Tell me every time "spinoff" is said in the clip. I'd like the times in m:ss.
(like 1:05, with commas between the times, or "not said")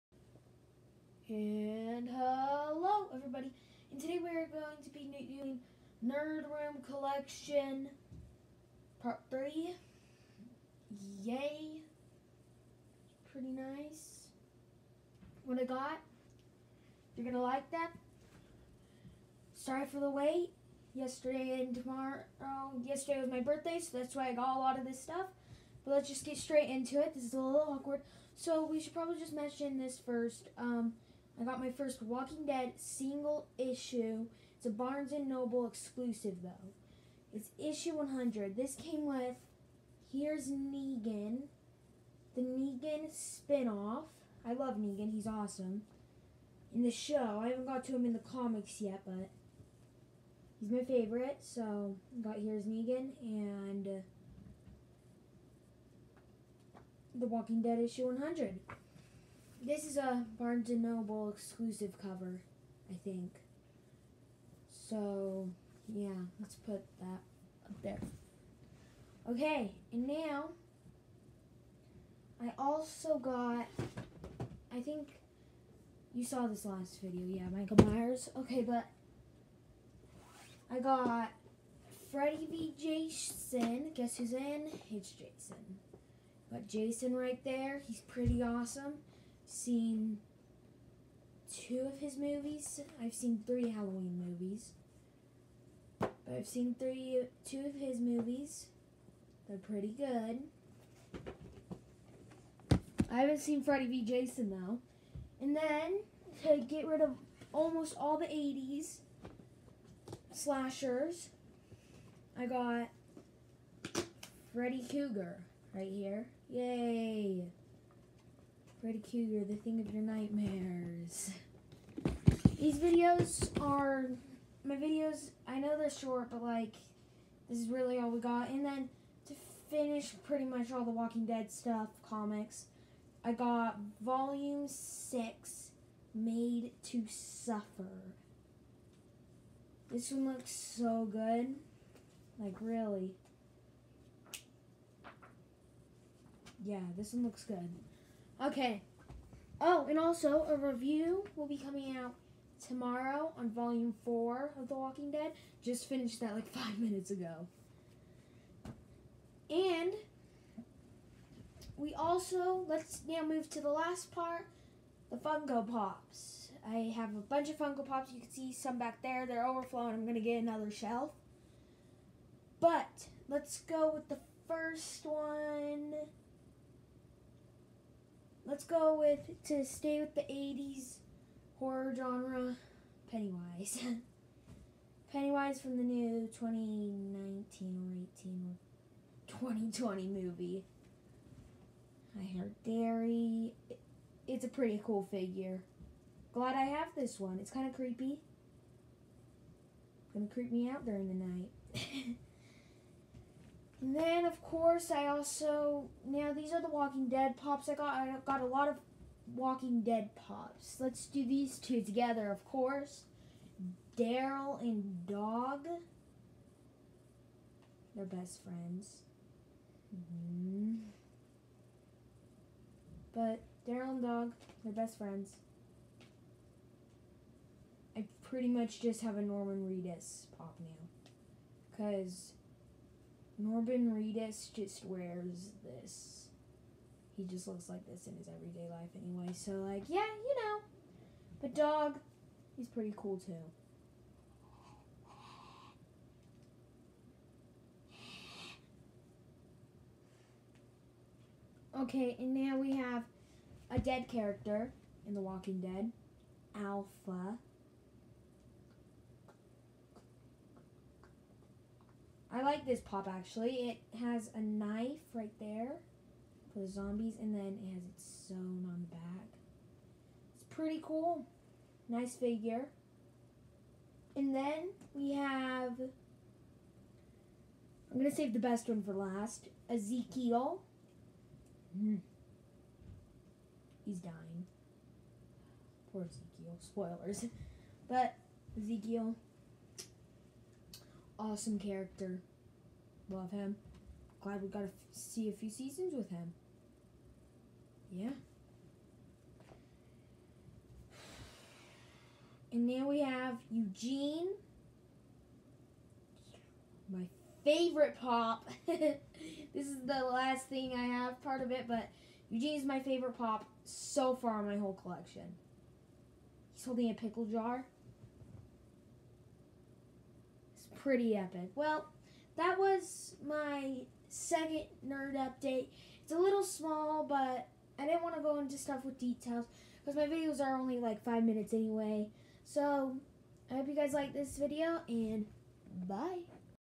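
0:43.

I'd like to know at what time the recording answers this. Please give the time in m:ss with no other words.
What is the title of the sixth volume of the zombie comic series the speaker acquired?
2:16.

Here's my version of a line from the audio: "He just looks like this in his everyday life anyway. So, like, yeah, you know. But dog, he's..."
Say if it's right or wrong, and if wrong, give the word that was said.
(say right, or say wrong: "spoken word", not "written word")
right.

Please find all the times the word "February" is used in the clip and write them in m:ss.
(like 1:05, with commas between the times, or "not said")
not said.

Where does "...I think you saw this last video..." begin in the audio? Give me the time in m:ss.
1:14.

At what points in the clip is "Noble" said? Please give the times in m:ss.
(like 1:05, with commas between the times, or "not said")
0:35, 1:00.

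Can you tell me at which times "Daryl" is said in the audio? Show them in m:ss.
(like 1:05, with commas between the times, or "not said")
3:33, 3:43.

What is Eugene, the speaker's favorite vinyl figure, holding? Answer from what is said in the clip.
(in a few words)
A pickle jar.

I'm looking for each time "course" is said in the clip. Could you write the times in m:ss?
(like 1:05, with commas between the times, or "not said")
3:24, 3:32.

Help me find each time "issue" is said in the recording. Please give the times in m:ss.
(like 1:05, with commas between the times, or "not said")
0:33, 0:37, 0:57.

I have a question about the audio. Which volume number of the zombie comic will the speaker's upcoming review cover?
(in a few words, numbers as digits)
4.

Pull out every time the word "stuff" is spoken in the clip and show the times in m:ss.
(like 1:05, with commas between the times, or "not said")
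0:25, 2:11, 5:28.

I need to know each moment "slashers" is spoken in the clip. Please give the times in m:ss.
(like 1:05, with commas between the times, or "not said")
1:50.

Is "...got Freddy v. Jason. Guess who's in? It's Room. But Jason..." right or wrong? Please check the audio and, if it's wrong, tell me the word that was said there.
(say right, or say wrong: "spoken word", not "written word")
wrong: "Jason", not "Room".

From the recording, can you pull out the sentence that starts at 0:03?
And today we are going to be doing Nerd Room Collection Part 3.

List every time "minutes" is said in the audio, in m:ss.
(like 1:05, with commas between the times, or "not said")
2:36, 5:31.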